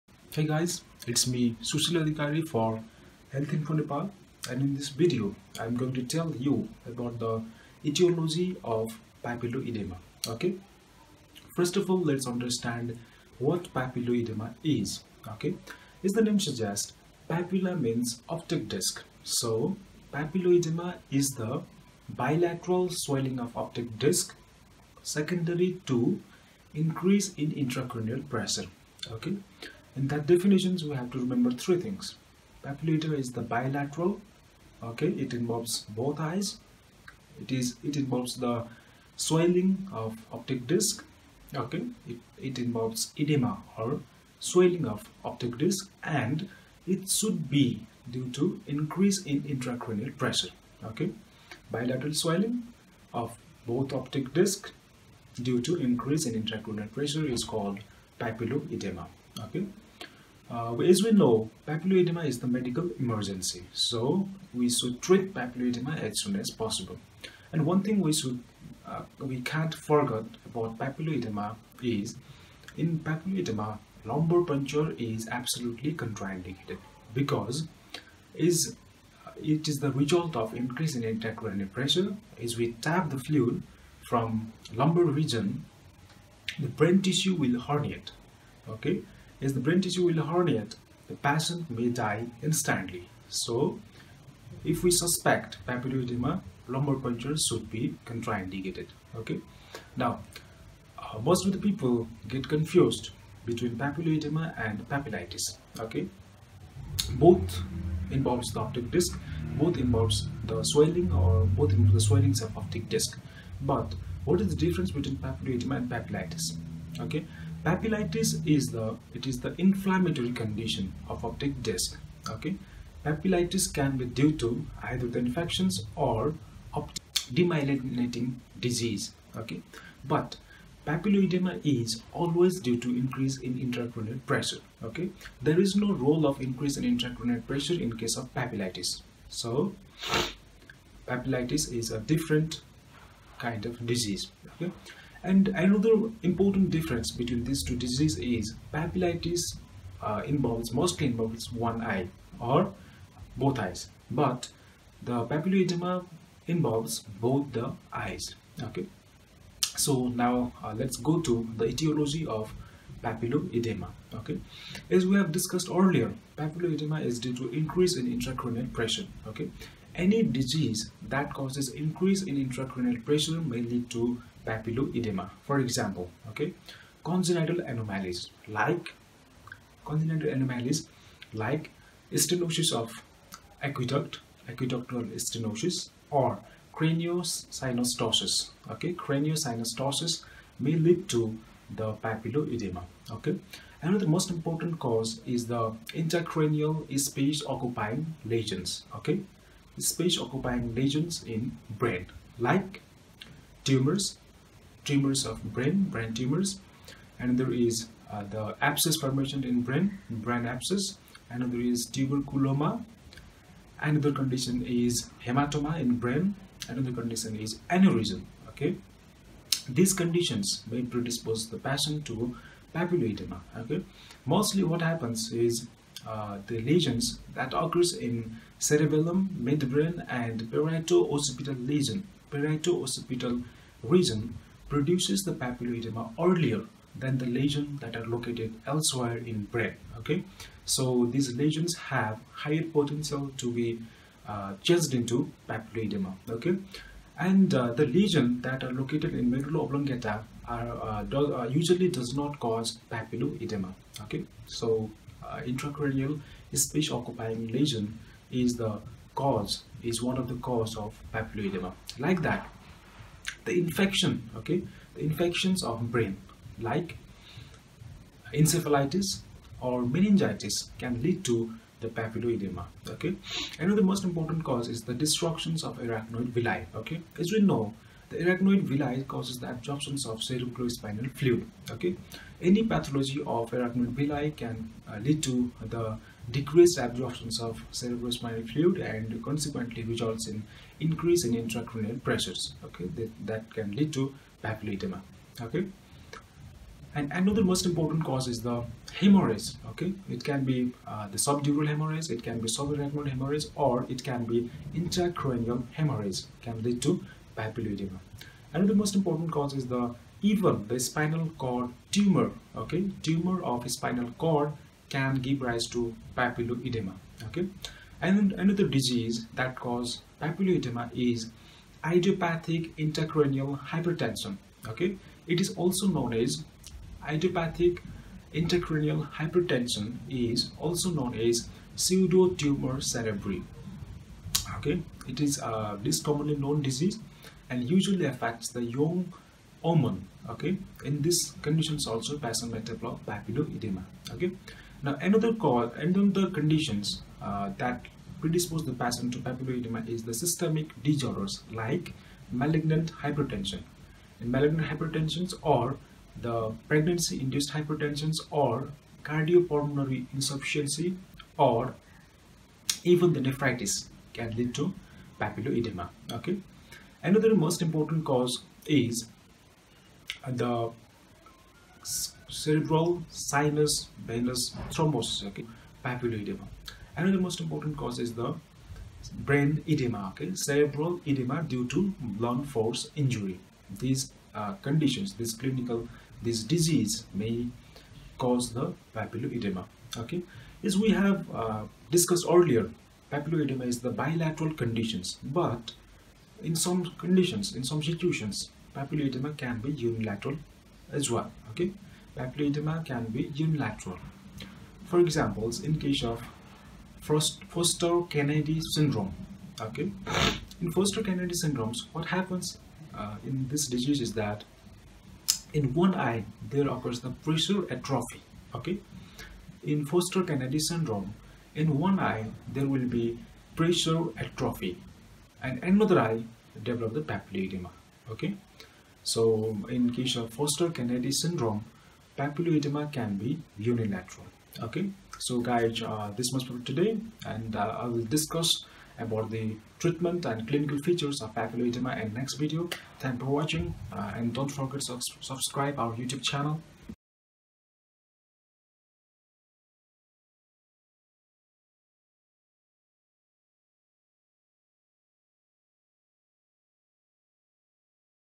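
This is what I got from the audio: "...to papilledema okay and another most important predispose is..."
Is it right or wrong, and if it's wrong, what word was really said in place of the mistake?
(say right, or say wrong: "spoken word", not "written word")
wrong: "cause", not "predispose".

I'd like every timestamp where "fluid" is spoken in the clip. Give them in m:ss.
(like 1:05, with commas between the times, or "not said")
1:23, 4:41, 4:48.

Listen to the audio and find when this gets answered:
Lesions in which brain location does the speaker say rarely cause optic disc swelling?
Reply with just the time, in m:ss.
4:09.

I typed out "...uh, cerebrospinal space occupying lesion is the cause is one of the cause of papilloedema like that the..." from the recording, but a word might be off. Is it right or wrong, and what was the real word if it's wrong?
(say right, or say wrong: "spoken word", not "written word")
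wrong: "intracranial", not "cerebrospinal".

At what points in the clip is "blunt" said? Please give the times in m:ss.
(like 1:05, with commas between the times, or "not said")
6:22.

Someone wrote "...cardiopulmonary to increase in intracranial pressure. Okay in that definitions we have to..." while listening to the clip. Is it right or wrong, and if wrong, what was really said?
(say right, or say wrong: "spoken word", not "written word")
wrong: "secondary", not "cardiopulmonary".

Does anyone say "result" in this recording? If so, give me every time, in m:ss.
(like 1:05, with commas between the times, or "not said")
1:19, 4:49.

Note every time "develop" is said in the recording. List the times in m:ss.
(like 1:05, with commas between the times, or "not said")
5:42, 7:06.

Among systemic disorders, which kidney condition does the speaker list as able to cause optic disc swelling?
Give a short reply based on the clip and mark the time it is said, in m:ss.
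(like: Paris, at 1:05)
nephritis, at 6:03.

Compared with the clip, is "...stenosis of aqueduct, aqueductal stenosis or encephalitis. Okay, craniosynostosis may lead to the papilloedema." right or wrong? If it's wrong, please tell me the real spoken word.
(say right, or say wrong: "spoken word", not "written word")
wrong: "craniosynostosis", not "encephalitis".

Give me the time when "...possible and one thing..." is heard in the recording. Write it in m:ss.
1:06.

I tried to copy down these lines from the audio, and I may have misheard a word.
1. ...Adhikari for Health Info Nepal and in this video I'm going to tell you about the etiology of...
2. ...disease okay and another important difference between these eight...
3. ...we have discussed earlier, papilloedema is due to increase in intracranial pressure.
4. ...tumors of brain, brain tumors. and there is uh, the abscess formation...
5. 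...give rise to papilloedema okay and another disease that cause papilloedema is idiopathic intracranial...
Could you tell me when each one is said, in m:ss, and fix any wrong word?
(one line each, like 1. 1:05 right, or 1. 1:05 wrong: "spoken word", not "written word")
1. 0:02 right
2. 2:23 wrong: "two", not "eight"
3. 2:45 right
4. 3:24 right
5. 5:15 right.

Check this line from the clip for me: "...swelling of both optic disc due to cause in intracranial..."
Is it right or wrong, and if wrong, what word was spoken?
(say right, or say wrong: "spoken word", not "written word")
wrong: "increase", not "cause".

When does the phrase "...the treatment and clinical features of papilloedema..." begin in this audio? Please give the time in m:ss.
7:19.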